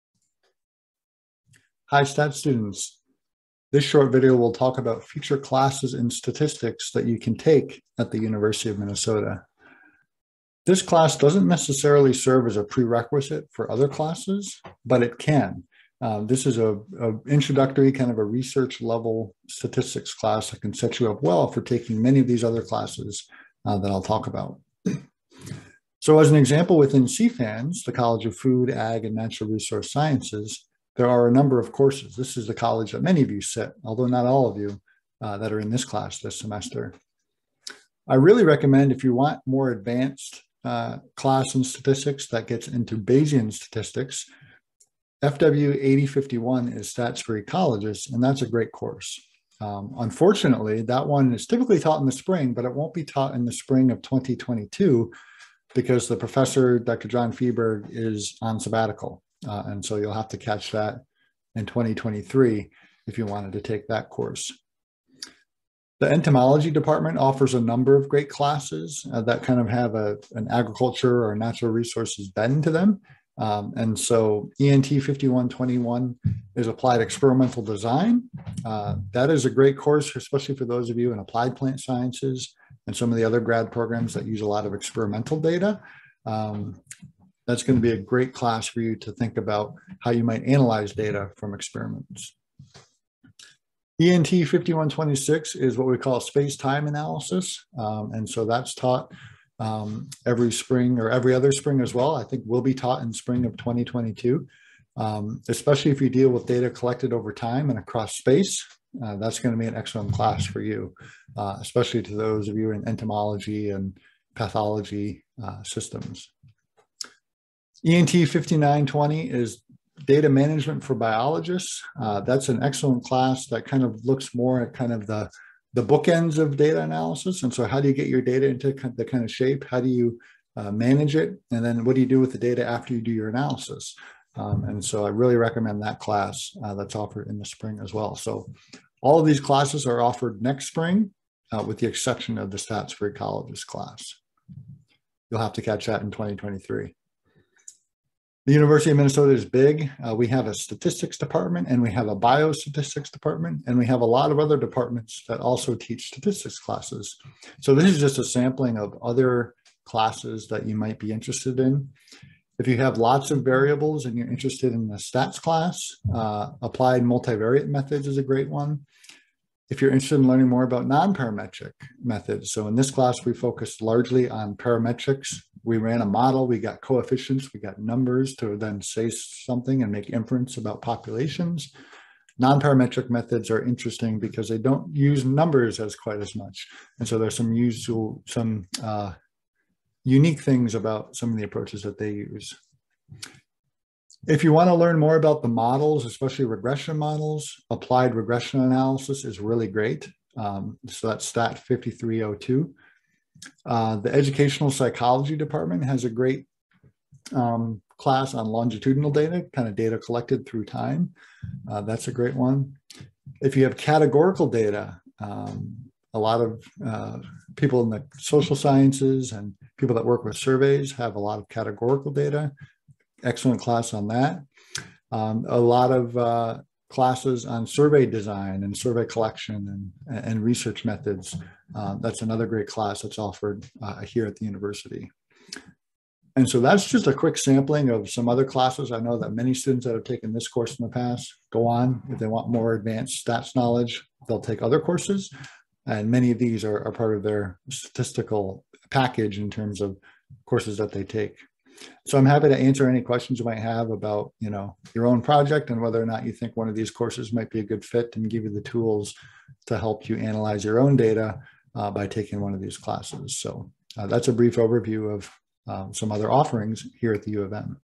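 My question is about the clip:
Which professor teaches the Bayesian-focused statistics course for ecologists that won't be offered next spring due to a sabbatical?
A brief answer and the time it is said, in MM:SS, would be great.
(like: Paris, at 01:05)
John Fieberg, at 00:56.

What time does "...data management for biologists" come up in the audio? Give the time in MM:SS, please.
02:00.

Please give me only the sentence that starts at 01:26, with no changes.
Um, that's going to be a great class for you to think about how you might analyze data from experiments.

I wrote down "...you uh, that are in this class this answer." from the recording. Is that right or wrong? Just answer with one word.
wrong.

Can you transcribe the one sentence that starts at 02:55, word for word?
We ran a model, we got coefficients, we got numbers to then say something and make inference about populations.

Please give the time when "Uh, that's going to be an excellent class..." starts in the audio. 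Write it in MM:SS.
01:49.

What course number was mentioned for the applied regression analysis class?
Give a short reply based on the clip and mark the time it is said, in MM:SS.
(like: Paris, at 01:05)
STAT 5302, at 03:21.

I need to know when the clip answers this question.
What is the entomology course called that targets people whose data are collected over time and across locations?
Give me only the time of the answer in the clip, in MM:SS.
01:36.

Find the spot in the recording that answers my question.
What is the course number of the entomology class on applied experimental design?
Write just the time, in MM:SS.
01:14.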